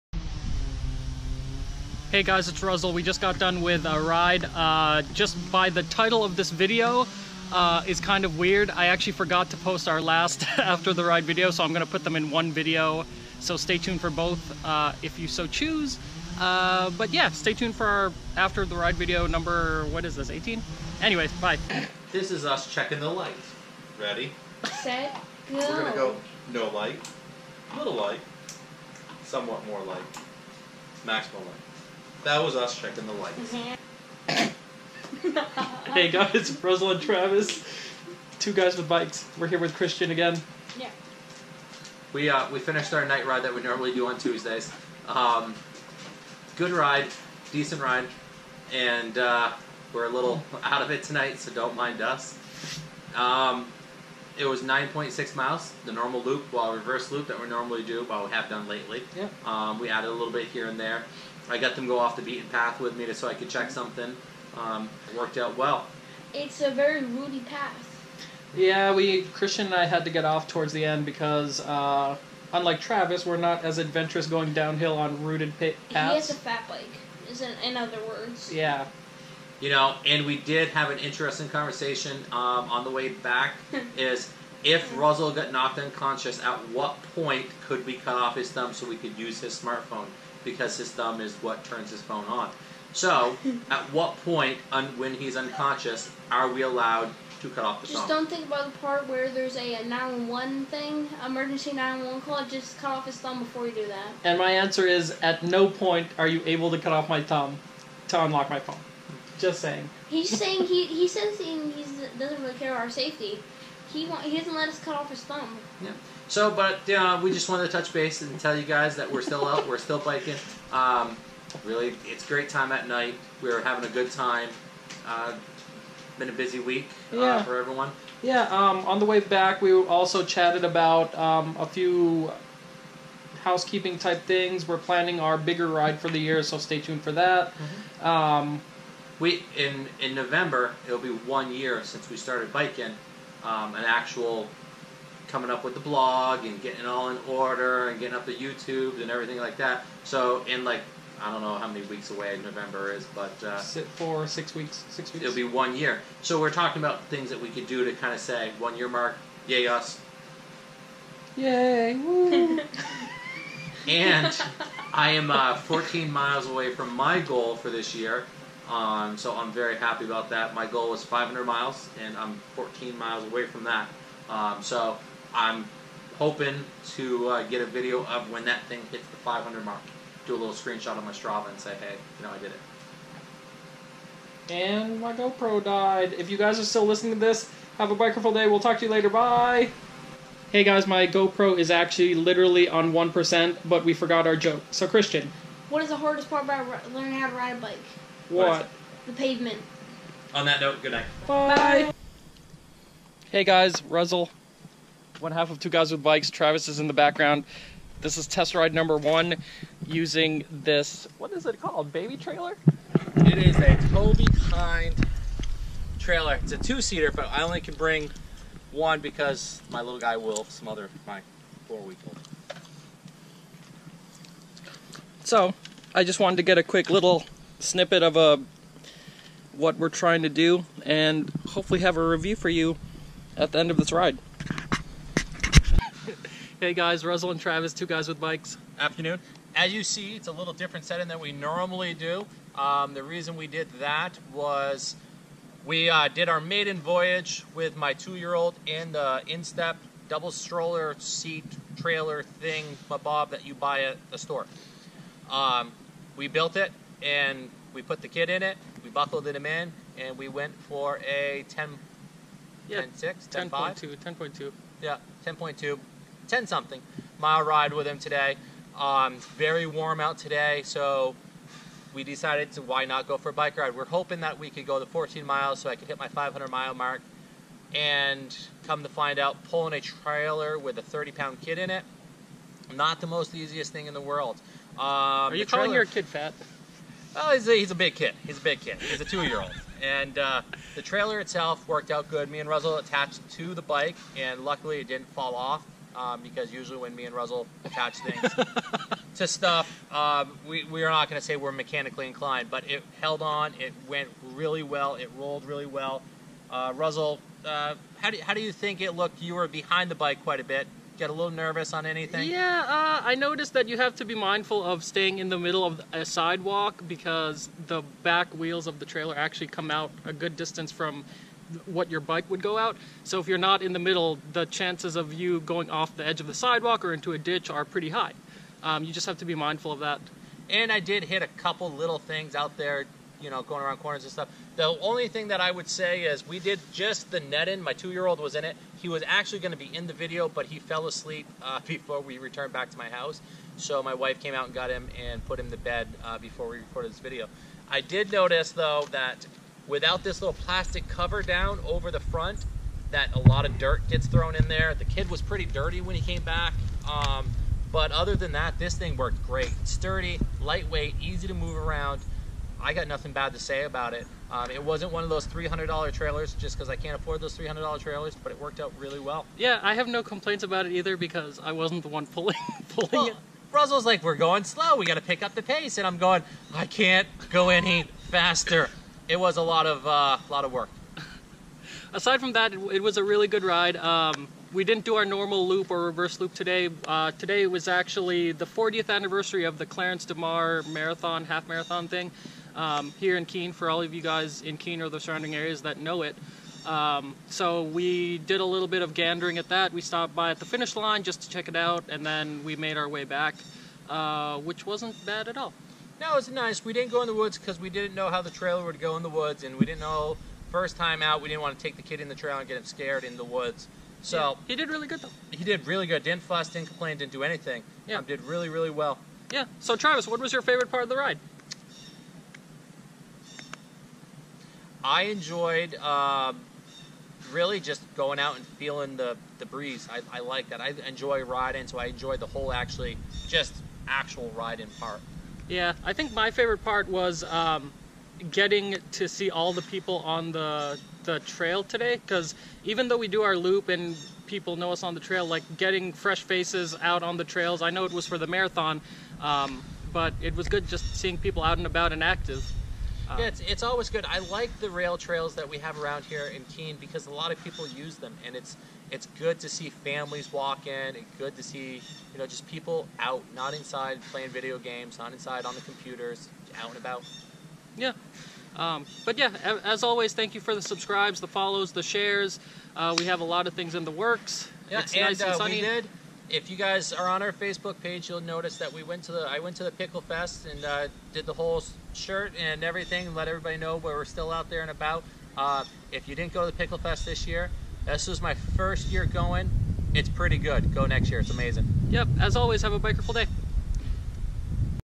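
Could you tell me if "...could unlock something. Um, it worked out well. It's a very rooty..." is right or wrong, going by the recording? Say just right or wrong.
wrong.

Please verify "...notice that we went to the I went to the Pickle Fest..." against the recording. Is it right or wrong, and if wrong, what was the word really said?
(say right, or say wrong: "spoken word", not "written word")
right.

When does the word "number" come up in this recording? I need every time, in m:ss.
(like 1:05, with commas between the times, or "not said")
0:19, 3:28.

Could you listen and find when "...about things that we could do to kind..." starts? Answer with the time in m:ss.
2:36.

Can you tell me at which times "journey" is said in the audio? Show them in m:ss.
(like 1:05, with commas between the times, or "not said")
not said.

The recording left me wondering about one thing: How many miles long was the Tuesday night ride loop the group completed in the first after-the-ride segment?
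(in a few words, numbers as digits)
9.6.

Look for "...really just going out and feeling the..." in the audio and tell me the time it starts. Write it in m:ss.
7:07.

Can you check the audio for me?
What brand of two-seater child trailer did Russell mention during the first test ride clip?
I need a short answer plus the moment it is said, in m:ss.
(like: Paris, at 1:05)
Toby Kind, at 3:33.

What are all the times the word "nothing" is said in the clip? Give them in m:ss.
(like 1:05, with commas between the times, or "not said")
6:02.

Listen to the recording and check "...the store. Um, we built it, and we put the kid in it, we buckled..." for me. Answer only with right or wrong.
right.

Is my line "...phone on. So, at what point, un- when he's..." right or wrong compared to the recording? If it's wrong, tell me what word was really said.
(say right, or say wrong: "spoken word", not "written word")
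right.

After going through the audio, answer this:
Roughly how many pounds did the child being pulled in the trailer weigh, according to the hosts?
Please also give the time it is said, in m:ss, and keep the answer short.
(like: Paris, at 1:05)
30, at 4:40.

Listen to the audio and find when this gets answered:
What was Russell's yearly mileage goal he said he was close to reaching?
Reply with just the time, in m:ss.
2:51.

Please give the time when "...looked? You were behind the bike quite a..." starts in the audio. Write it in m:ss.
5:08.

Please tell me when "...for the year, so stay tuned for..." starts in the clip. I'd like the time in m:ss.
2:15.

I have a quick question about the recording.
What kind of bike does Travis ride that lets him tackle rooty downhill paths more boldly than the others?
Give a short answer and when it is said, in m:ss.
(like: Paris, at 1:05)
fat bike, at 1:16.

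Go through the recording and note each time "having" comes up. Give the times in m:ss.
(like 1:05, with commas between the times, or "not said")
2:03.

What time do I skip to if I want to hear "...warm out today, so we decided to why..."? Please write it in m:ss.
4:29.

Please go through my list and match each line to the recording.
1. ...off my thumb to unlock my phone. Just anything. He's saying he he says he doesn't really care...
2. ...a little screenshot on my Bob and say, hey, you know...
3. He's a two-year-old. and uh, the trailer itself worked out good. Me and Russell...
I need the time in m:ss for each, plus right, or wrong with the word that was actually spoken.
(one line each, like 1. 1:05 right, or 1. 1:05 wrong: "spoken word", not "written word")
1. 1:46 wrong: "saying", not "anything"
2. 3:00 wrong: "Strava", not "Bob"
3. 4:48 right.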